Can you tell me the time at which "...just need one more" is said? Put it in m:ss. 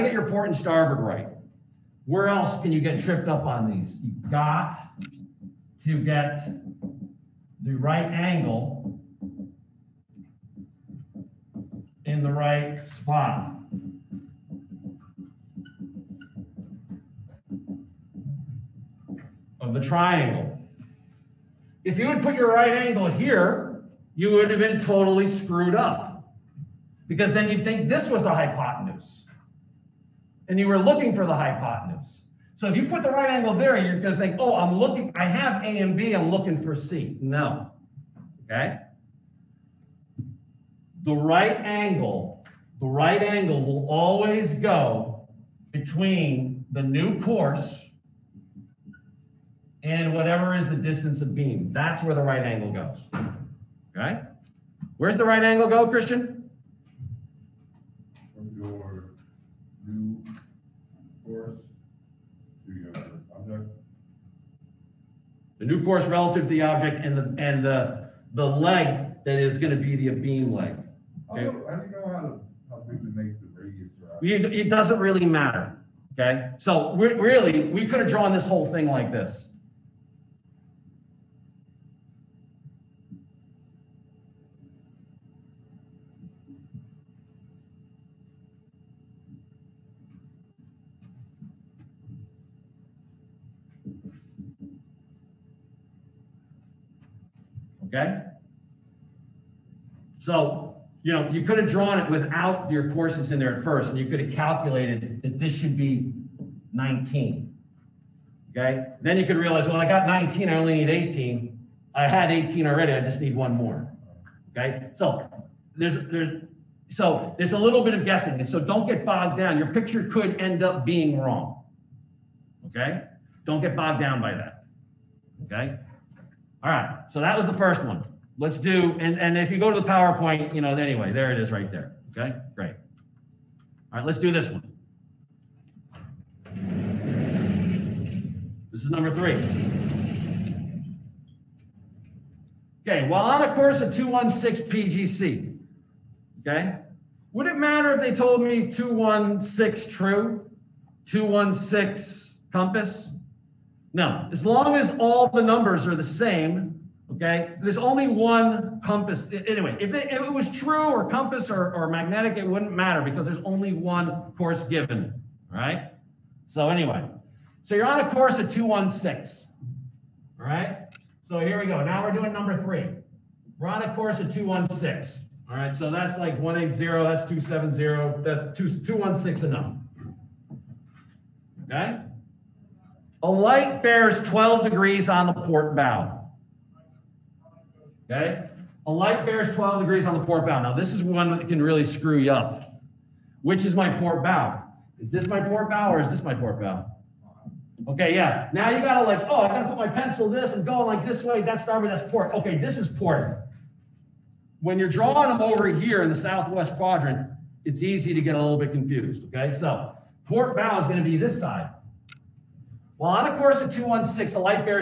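1:52.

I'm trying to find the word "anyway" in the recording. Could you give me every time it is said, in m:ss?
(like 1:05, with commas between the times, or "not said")
2:10, 2:39, 2:46.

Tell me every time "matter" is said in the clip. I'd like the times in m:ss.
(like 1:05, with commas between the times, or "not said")
1:15, 2:27, 2:42.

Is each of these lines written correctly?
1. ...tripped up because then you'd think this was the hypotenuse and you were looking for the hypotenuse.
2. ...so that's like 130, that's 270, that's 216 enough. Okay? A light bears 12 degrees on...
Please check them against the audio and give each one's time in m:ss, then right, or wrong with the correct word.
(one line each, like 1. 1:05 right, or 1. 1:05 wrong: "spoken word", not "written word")
1. 0:25 wrong: "screwed", not "tripped"
2. 2:55 wrong: "180", not "130".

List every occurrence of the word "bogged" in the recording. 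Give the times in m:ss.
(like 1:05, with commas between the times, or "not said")
1:59, 2:03.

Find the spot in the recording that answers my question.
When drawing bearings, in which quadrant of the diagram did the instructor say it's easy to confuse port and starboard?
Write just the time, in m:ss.
3:26.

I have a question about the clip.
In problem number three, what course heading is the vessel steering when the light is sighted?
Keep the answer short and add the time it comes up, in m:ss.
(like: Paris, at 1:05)
216, at 2:23.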